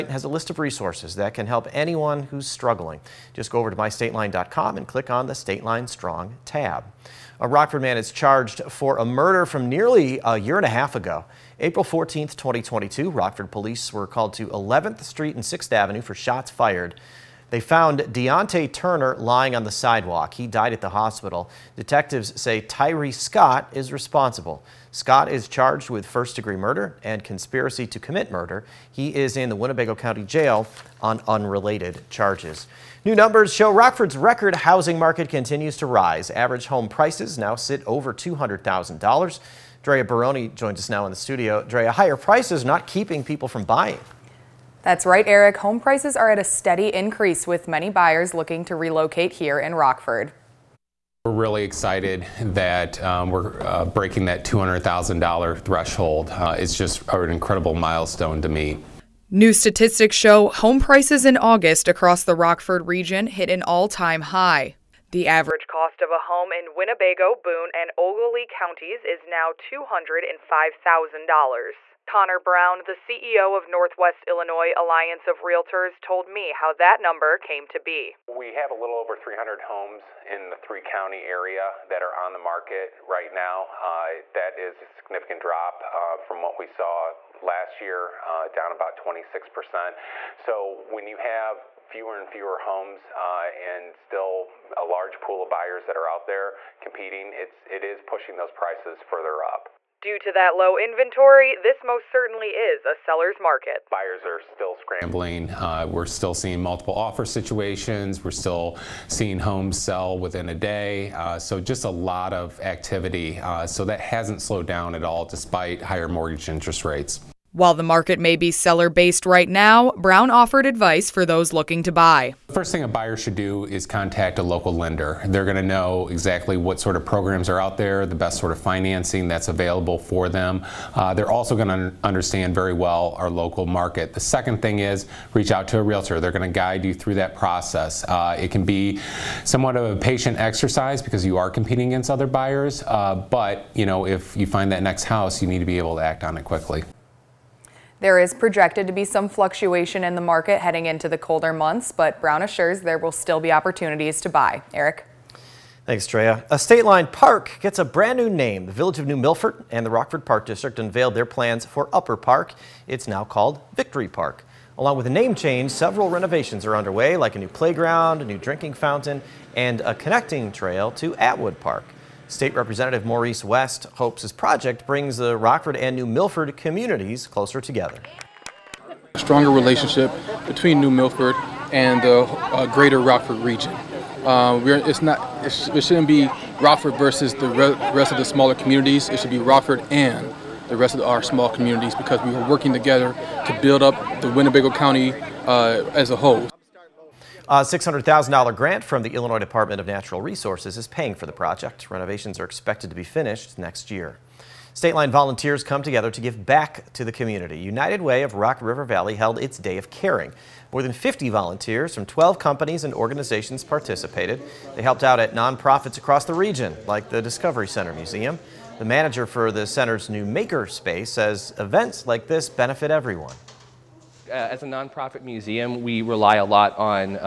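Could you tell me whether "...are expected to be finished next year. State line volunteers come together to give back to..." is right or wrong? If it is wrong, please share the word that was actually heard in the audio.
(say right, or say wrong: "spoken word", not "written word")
right.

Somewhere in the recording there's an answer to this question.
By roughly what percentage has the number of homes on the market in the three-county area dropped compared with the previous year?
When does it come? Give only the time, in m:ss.
1:28.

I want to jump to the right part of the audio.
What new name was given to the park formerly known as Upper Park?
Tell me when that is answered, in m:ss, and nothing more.
2:43.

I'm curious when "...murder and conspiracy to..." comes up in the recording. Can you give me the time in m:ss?
0:26.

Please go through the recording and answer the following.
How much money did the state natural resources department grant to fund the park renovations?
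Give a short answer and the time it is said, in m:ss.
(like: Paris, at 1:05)
$600,000, at 3:17.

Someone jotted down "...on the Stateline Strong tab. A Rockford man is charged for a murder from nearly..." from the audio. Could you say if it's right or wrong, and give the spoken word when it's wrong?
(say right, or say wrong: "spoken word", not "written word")
right.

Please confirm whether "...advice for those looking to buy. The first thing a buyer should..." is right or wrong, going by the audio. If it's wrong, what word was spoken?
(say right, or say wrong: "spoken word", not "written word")
right.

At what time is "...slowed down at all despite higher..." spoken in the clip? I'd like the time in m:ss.
1:54.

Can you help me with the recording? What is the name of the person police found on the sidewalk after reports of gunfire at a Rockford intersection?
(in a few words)
Deontay Turner.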